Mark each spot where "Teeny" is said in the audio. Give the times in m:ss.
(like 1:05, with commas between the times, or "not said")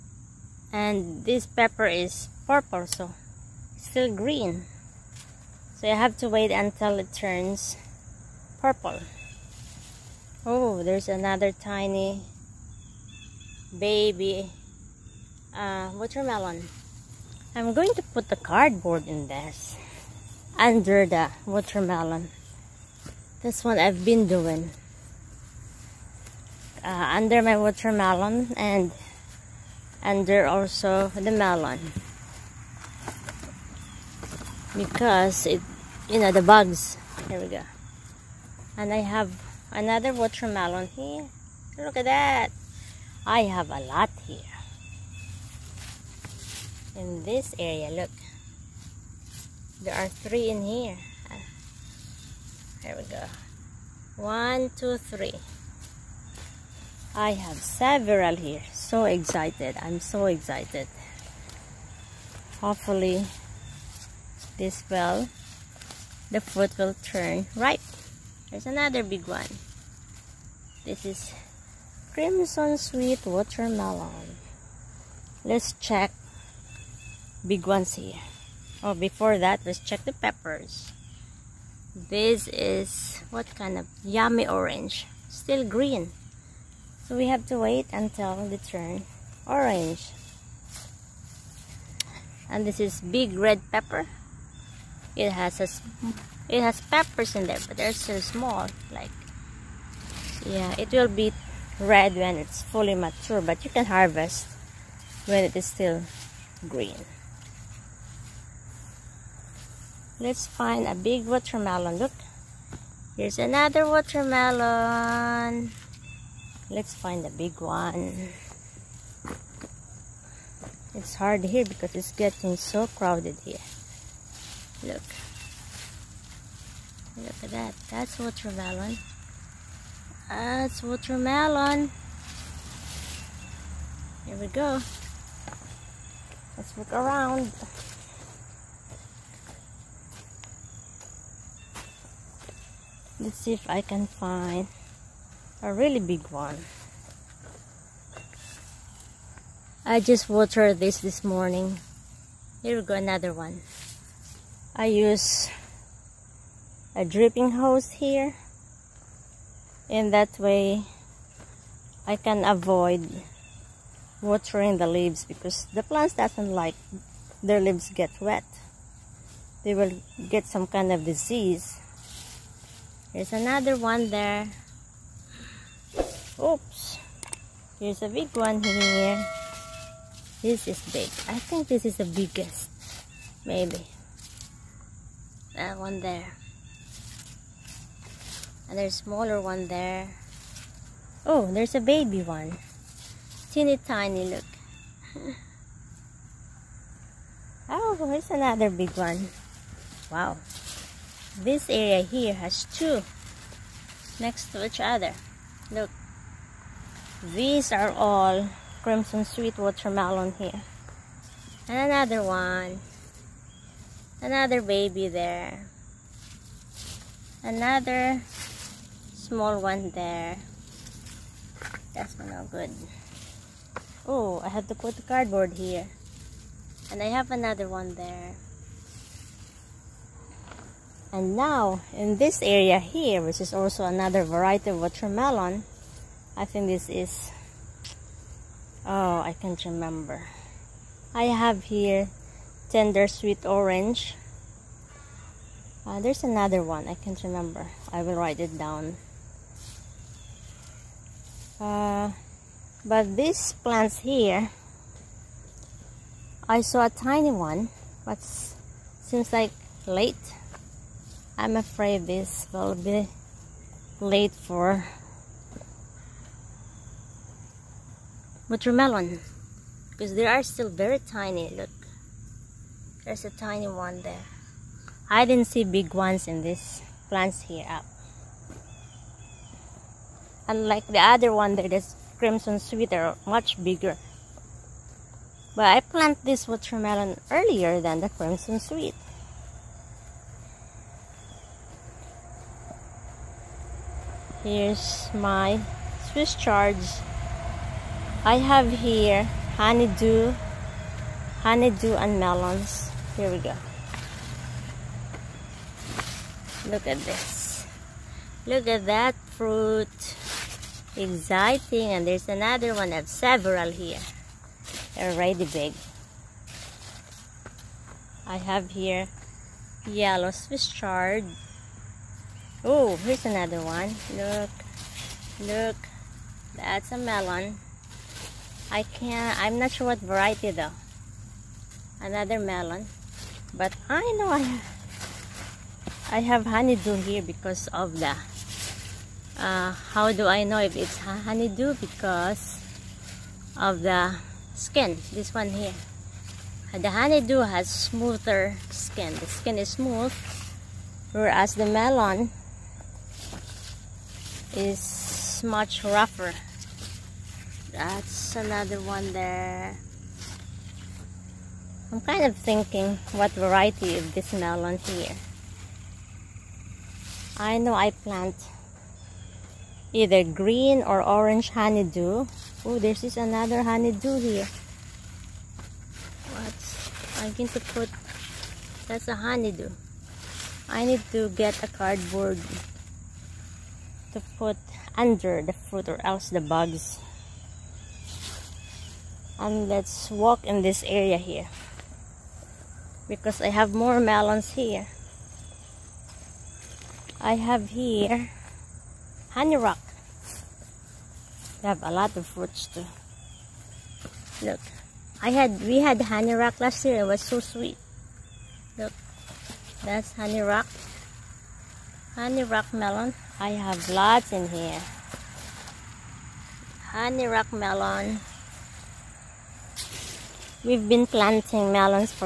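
3:13.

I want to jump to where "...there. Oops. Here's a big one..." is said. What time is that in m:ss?
2:54.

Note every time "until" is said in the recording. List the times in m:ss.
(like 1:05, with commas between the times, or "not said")
0:06, 1:27.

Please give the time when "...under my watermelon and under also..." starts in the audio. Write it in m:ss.
0:27.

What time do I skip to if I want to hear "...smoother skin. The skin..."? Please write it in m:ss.
5:47.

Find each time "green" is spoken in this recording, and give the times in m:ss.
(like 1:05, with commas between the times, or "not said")
0:04, 1:25, 1:46, 6:10.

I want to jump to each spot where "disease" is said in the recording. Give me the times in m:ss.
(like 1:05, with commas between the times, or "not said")
2:51.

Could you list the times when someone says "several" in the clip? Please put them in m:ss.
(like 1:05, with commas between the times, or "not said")
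0:57, 5:13.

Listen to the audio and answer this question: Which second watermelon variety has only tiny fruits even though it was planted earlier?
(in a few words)
Tender sweet orange.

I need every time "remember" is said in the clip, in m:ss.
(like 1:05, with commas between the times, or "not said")
3:59, 4:07.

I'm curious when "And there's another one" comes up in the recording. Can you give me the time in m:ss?
5:11.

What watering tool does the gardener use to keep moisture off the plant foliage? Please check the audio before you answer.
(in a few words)
Dripping hose.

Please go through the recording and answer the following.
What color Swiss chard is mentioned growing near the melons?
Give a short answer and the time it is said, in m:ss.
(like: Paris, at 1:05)
Yellow, at 5:19.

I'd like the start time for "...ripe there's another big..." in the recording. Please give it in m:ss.
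1:07.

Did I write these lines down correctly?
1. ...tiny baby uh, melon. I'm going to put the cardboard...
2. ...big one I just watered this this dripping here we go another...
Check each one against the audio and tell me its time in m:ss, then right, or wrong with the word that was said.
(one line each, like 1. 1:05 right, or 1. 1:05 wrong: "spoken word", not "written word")
1. 0:11 wrong: "watermelon", not "melon"
2. 2:25 wrong: "morning", not "dripping".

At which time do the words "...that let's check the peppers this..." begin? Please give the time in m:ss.
1:19.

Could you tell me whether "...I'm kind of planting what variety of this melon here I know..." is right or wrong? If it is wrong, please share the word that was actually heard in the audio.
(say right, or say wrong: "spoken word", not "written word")
wrong: "thinking", not "planting".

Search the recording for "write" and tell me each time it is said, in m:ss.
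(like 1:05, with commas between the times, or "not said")
4:08.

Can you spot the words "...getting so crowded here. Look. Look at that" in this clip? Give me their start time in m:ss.
2:02.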